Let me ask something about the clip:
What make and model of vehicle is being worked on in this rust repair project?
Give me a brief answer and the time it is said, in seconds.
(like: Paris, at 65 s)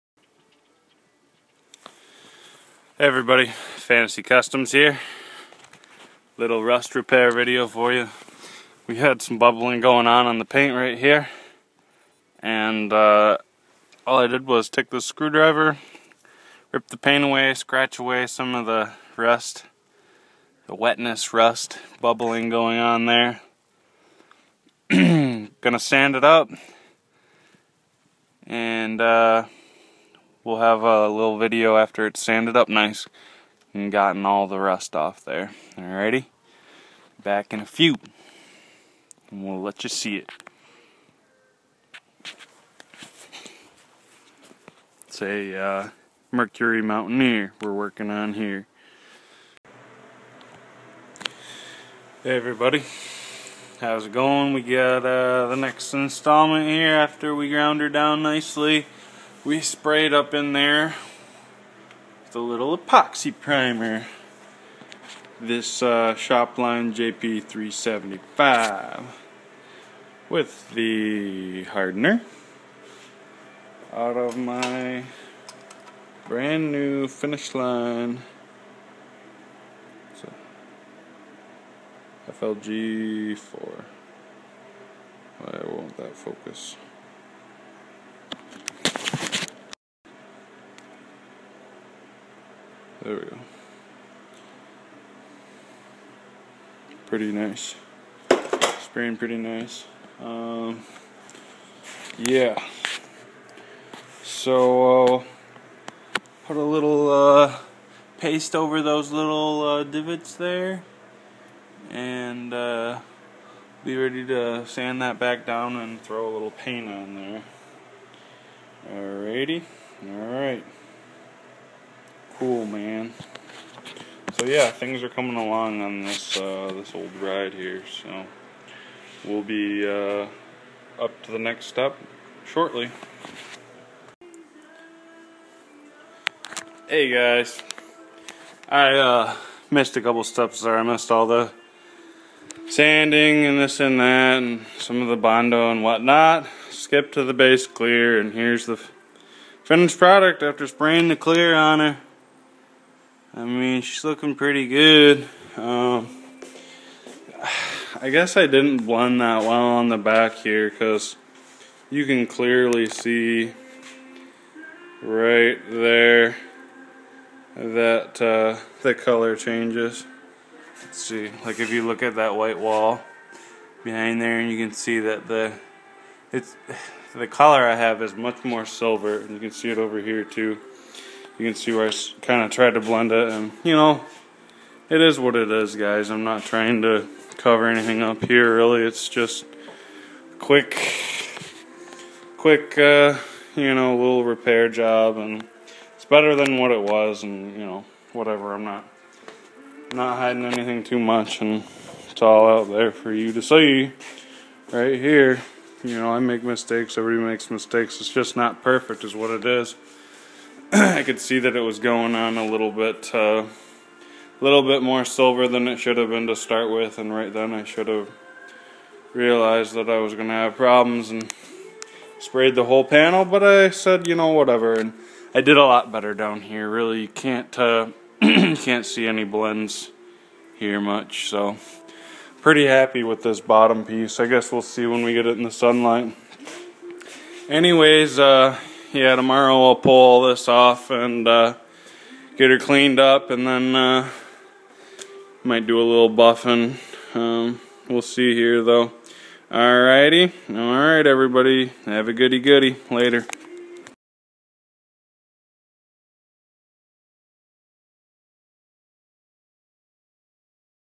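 Mercury Mountaineer, at 46 s.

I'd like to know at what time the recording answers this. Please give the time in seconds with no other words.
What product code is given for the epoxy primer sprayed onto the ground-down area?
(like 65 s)
66 s.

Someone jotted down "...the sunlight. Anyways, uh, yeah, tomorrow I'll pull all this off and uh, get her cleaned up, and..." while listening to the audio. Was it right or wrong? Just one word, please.
right.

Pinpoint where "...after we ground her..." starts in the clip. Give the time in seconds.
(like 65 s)
56 s.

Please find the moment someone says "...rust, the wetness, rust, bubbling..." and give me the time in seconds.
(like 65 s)
19 s.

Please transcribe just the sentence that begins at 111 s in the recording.
And uh, be ready to sand that back down and throw a little paint on there.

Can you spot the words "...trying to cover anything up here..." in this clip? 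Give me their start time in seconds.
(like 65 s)
186 s.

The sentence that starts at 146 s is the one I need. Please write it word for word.
Skip to the base clear, and here's the finished product after spraying the clear on her.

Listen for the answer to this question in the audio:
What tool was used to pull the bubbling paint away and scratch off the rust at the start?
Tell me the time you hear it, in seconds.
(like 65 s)
15 s.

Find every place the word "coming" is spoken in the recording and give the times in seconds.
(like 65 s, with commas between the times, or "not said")
125 s.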